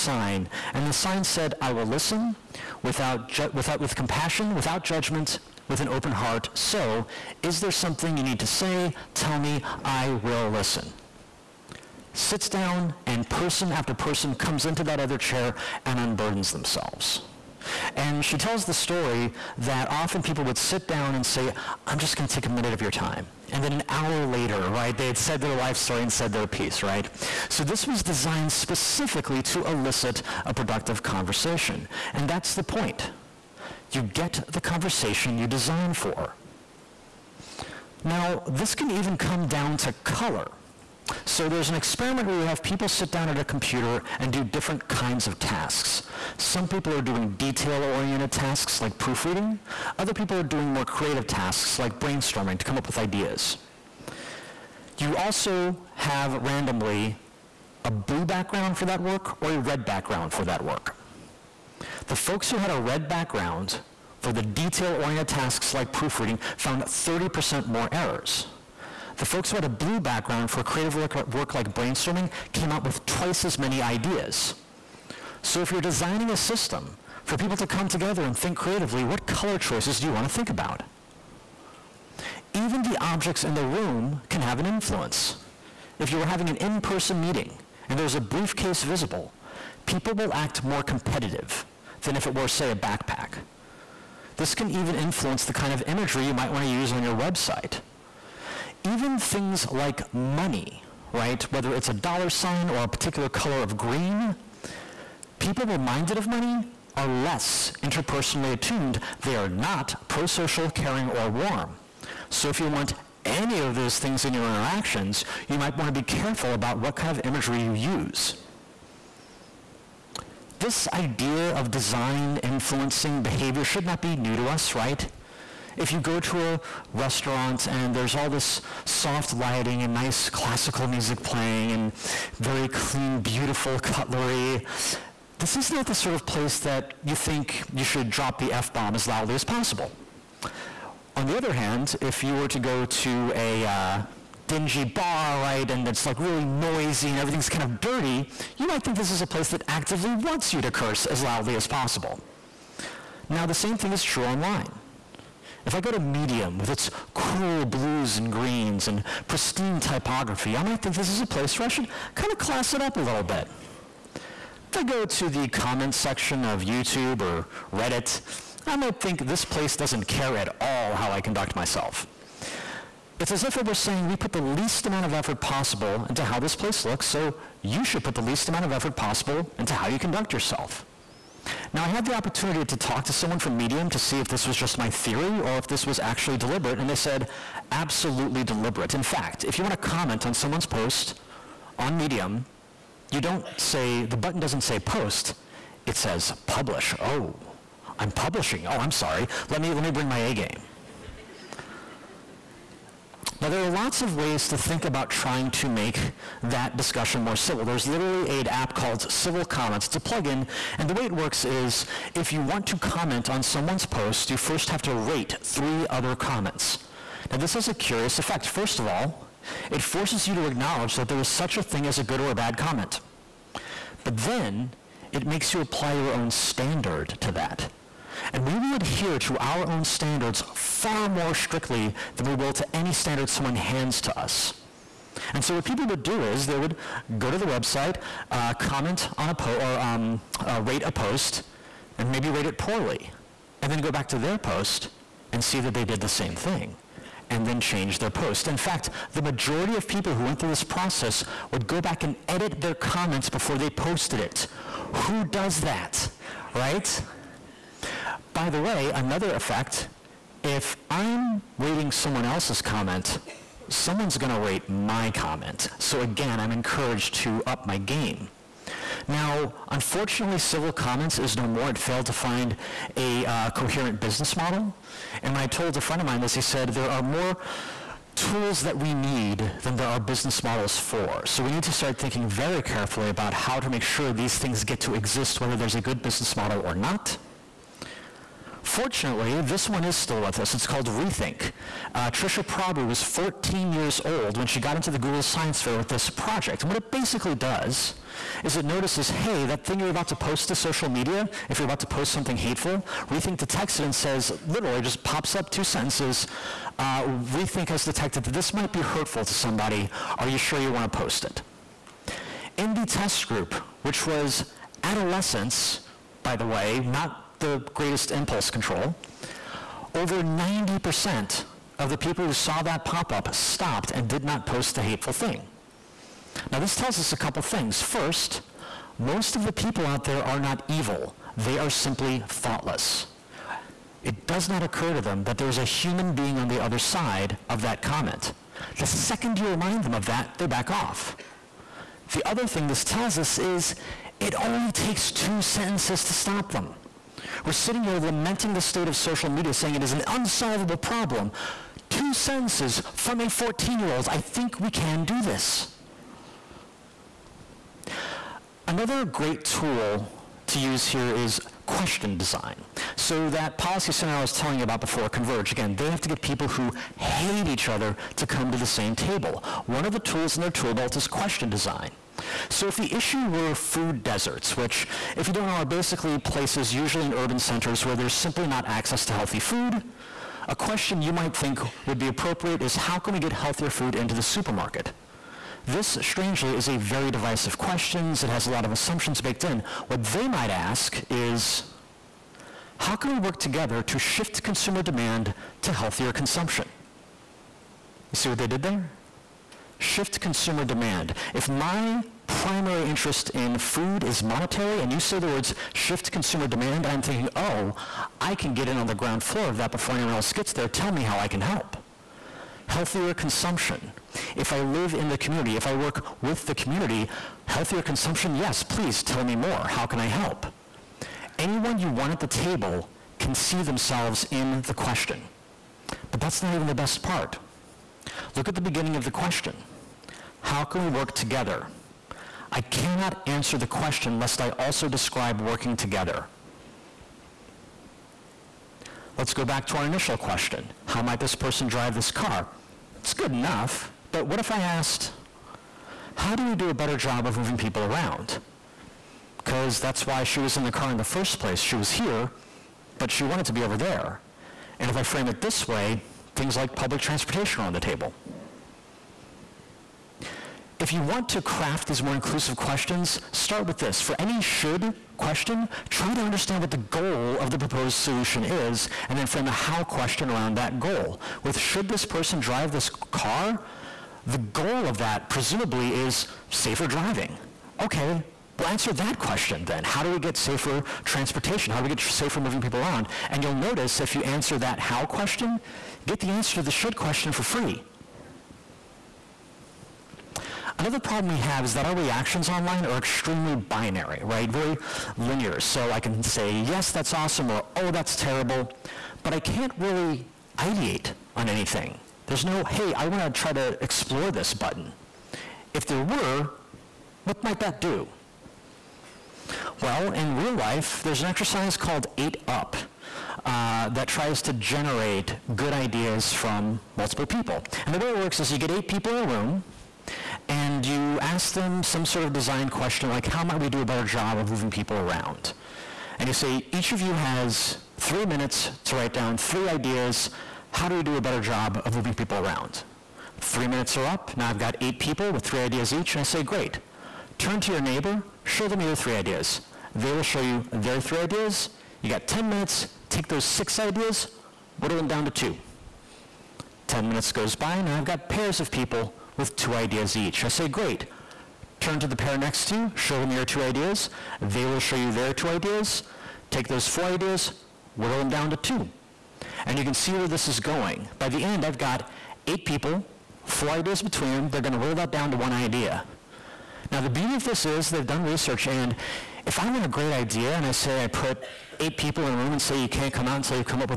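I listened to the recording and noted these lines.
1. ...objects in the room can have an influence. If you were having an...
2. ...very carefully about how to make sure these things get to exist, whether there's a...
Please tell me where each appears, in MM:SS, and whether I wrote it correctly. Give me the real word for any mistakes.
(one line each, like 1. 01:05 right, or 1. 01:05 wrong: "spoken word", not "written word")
1. 01:22 right
2. 04:42 right.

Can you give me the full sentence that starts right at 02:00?
This idea of design influencing behavior should not be new to us, right?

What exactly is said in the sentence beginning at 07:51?
With should this person drive this car, the goal of that presumably is safer driving.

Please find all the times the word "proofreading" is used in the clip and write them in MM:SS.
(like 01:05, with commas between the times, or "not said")
00:48, 01:05.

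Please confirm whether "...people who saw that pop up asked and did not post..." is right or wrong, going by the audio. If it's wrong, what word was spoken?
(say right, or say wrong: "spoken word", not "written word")
wrong: "stopped", not "asked".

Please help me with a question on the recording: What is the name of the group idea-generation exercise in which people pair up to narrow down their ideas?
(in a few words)
8UP.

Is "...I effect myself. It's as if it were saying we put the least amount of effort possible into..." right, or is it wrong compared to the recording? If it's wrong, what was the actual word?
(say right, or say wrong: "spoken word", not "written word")
wrong: "conduct", not "effect".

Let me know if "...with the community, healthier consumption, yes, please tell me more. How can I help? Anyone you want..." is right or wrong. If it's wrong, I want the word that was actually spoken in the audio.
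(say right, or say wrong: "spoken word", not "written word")
right.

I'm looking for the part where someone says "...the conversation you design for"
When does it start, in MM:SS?
00:34.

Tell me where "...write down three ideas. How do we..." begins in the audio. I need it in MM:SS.
08:48.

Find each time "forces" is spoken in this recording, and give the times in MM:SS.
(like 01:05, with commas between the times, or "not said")
03:39.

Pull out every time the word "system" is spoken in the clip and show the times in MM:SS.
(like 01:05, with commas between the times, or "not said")
01:16.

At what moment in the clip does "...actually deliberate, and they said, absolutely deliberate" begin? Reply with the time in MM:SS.
03:05.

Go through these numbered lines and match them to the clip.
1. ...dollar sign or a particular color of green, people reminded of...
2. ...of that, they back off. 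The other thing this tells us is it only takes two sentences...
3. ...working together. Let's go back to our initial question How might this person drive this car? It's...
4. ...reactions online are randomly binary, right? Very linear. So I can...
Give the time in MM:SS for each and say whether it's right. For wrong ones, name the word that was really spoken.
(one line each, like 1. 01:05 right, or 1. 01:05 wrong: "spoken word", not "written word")
1. 01:41 right
2. 05:39 right
3. 07:15 right
4. 08:11 wrong: "extremely", not "randomly".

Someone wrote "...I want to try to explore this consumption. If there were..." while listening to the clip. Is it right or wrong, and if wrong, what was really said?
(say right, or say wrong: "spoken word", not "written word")
wrong: "button", not "consumption".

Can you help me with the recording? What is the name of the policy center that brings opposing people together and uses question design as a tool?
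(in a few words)
Converge.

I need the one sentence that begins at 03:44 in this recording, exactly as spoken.
But then, it makes you apply your own standard to that.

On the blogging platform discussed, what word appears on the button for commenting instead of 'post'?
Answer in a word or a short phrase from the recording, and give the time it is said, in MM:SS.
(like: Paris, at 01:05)
Publish, at 03:16.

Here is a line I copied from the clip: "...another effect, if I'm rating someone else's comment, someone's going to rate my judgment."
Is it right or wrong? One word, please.
wrong.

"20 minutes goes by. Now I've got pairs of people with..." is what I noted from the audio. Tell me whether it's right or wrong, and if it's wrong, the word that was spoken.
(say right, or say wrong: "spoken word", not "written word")
wrong: "10", not "20".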